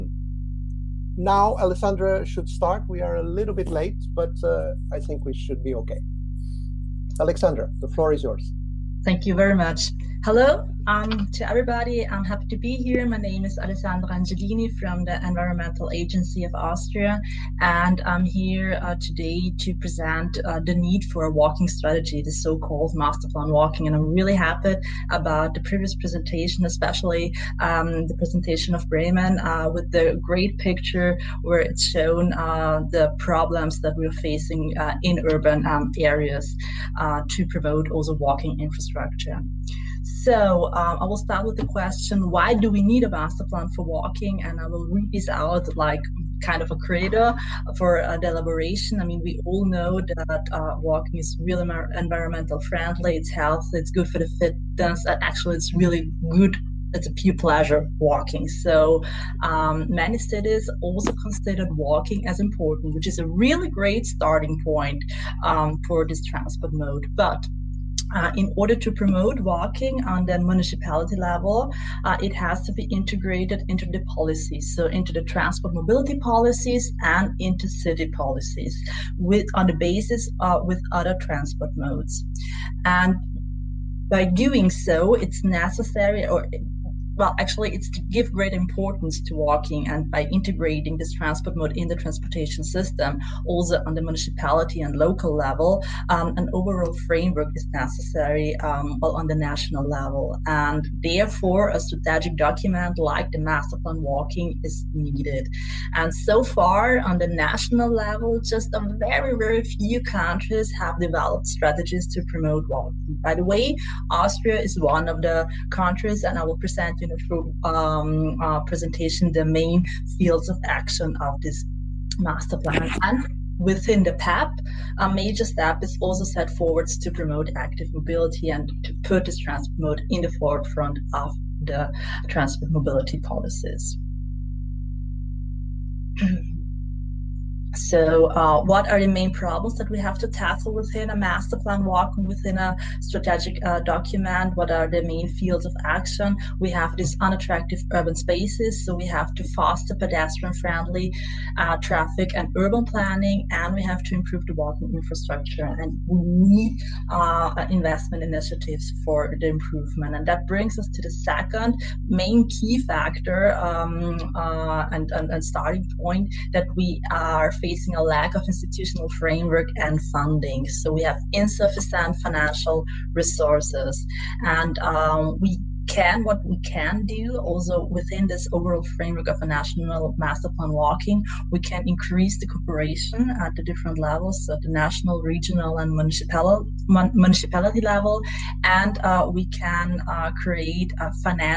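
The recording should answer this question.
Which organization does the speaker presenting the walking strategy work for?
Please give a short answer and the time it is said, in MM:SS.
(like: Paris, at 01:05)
Environmental Agency of Austria, at 00:15.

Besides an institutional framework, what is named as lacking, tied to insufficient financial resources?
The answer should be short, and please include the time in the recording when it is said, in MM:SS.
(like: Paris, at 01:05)
Funding, at 02:50.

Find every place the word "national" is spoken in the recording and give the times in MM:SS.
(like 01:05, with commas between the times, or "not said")
01:39, 01:47, 02:59, 03:04.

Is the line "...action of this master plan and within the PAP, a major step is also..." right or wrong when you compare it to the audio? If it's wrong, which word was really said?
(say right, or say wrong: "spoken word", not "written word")
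right.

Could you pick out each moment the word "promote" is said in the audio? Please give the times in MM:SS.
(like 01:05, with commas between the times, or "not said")
00:37, 01:08, 01:52, 02:07.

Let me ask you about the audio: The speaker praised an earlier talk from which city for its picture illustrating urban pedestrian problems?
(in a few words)
Bremen.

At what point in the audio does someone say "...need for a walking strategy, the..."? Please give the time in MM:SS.
00:20.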